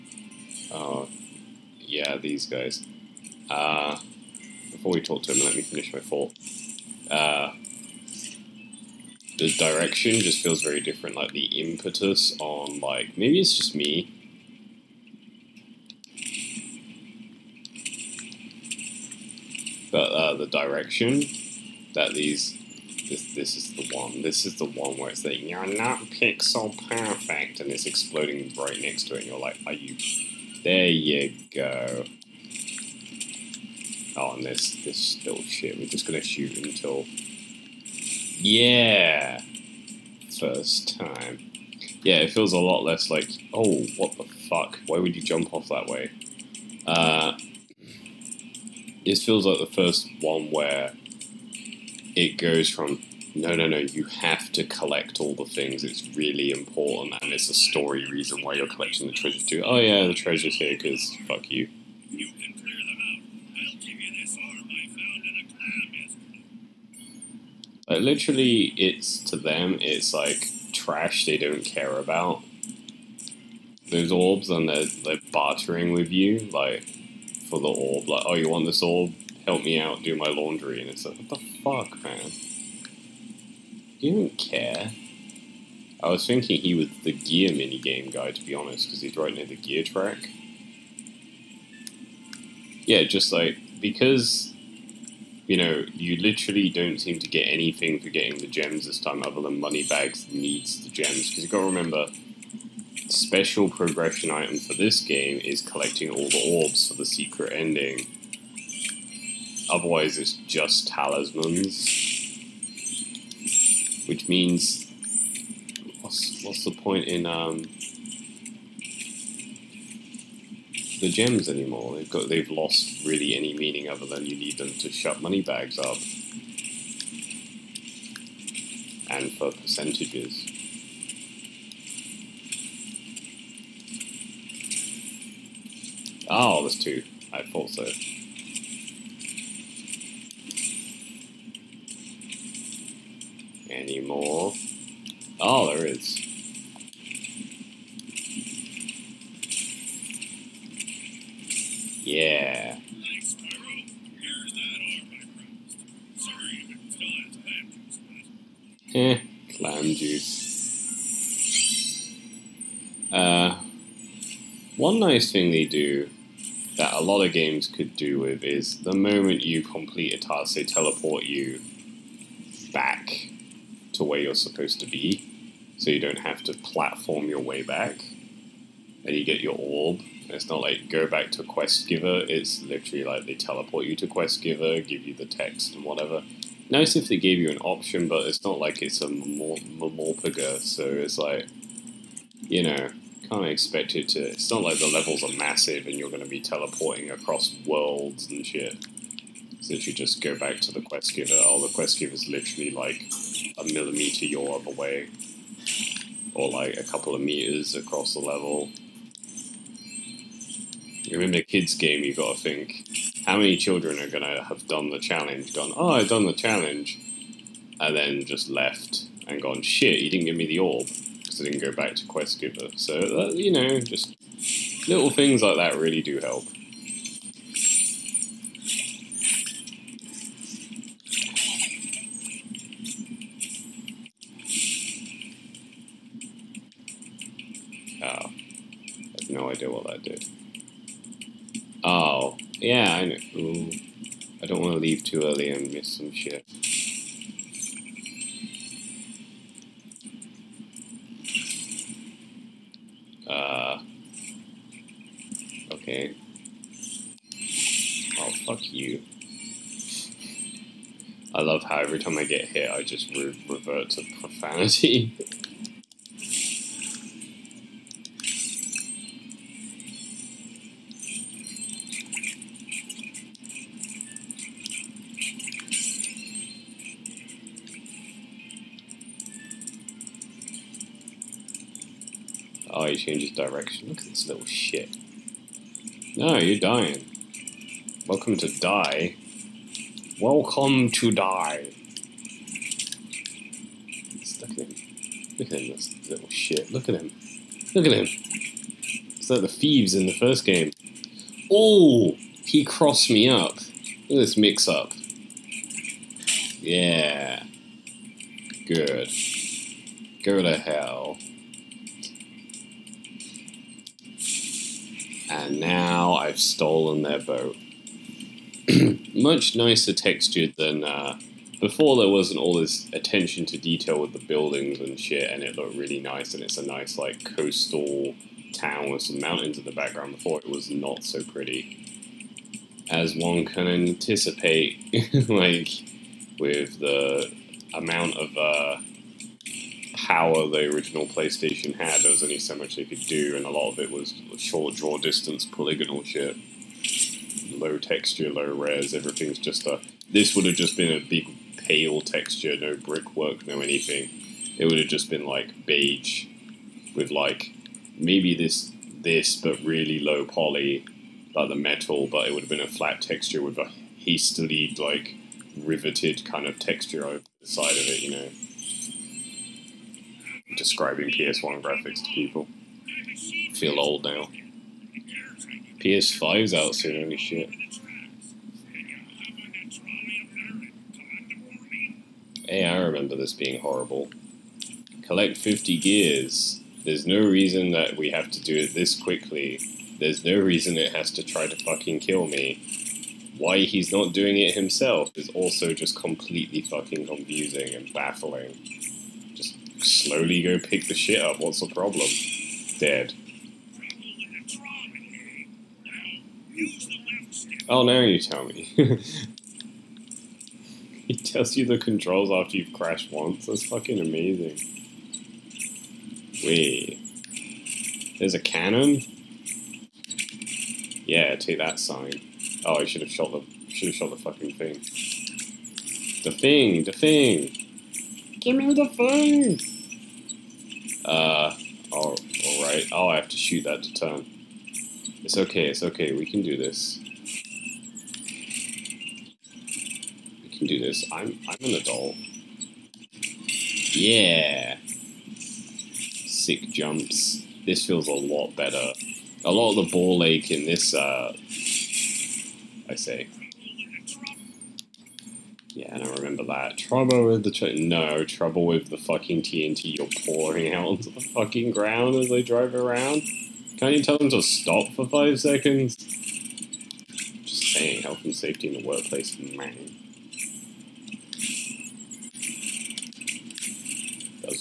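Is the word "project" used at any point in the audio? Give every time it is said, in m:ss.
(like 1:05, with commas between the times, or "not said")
not said.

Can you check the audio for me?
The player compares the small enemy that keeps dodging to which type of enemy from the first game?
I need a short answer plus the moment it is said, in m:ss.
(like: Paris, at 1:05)
the thieves, at 4:59.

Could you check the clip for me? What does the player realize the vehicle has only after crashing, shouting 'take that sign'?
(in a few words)
a cannon.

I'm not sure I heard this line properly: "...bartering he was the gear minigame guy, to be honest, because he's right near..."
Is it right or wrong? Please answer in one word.
wrong.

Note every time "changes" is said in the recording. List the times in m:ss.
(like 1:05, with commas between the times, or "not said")
4:43.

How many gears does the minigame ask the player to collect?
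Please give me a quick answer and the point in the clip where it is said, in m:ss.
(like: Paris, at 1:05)
50, at 6:25.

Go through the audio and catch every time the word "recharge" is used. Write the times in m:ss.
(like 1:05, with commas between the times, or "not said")
not said.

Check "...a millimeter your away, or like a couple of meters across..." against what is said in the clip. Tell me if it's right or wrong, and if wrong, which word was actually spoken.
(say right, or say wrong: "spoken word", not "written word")
right.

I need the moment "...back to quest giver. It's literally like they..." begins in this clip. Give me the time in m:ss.
3:01.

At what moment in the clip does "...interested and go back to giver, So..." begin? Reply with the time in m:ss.
3:41.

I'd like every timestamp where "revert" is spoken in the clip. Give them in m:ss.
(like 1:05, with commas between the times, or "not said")
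4:23.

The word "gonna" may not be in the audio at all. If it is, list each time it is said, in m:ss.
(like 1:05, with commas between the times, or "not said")
0:36, 3:34.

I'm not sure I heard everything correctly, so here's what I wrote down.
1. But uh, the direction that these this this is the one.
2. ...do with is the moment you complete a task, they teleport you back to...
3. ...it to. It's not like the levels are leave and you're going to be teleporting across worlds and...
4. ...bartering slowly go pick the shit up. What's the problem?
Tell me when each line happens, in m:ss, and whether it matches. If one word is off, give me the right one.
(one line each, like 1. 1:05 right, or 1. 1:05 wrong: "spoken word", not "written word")
1. 0:19 right
2. 2:47 right
3. 3:13 wrong: "massive", not "leave"
4. 6:37 wrong: "baffling", not "bartering".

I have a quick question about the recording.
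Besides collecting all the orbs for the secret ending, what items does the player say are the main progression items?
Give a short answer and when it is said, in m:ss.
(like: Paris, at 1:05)
talismans, at 1:50.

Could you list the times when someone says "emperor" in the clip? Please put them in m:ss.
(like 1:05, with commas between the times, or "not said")
not said.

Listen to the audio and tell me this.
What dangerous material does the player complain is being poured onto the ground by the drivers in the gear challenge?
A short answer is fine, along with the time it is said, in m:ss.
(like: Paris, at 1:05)
TNT, at 7:39.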